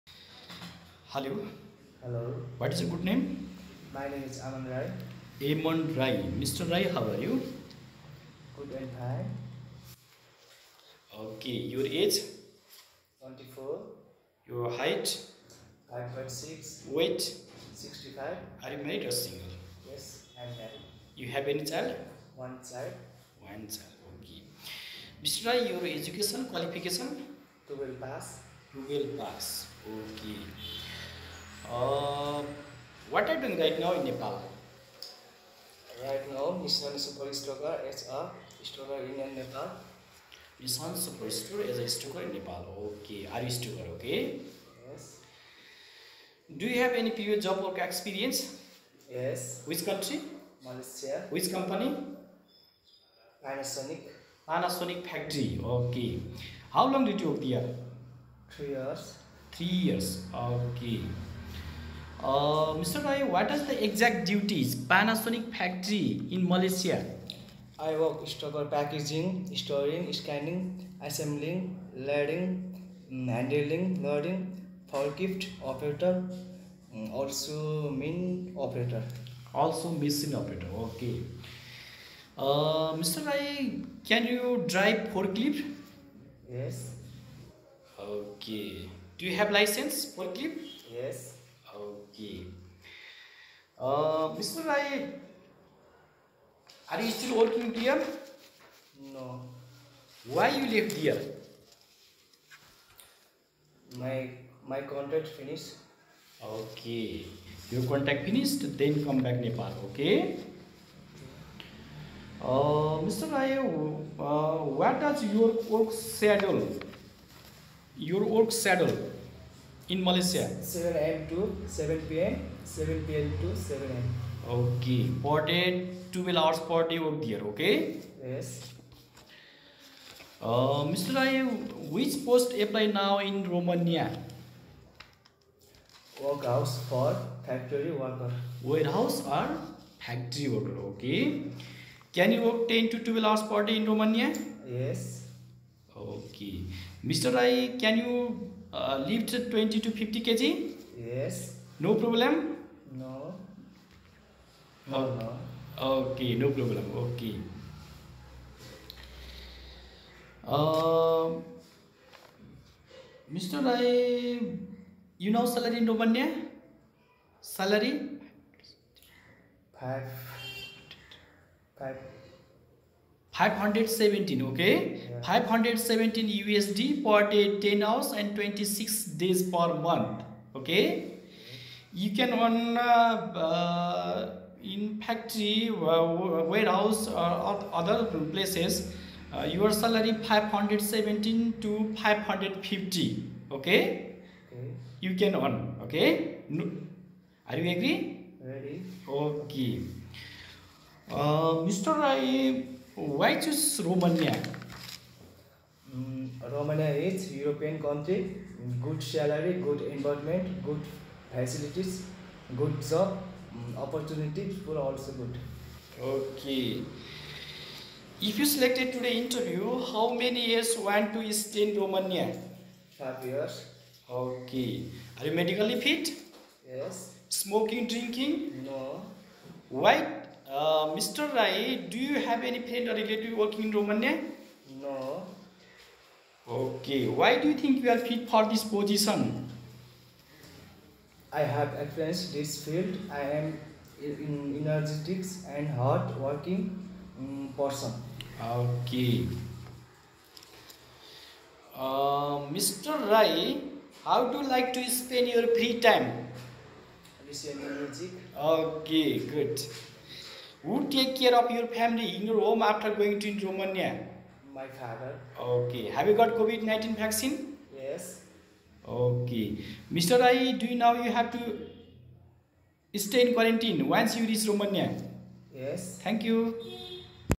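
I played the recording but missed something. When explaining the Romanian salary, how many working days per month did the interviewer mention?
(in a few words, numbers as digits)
26.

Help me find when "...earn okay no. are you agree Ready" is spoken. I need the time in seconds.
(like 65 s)
195 s.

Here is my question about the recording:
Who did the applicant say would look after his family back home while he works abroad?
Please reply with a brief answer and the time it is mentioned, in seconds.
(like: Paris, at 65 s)
My father, at 264 s.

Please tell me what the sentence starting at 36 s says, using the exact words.
Right now, Nissan Super Stoker is a stoker in Nepal.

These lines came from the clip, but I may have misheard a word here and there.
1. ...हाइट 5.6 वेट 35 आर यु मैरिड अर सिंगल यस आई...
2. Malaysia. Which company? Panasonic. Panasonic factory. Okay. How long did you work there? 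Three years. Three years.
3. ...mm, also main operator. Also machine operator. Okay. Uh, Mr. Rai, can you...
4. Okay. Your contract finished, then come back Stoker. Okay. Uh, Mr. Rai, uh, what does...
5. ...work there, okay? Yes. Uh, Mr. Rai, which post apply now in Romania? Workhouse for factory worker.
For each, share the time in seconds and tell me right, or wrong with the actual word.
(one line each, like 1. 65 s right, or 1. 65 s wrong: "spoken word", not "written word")
1. 14 s wrong: "65", not "35"
2. 50 s right
3. 76 s right
4. 106 s wrong: "Nepal", not "Stoker"
5. 126 s right.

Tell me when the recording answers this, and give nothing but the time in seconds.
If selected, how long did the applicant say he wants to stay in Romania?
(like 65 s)
222 s.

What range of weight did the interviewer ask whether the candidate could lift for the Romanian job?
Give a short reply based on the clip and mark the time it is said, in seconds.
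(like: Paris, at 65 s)
20 to 50 kg, at 149 s.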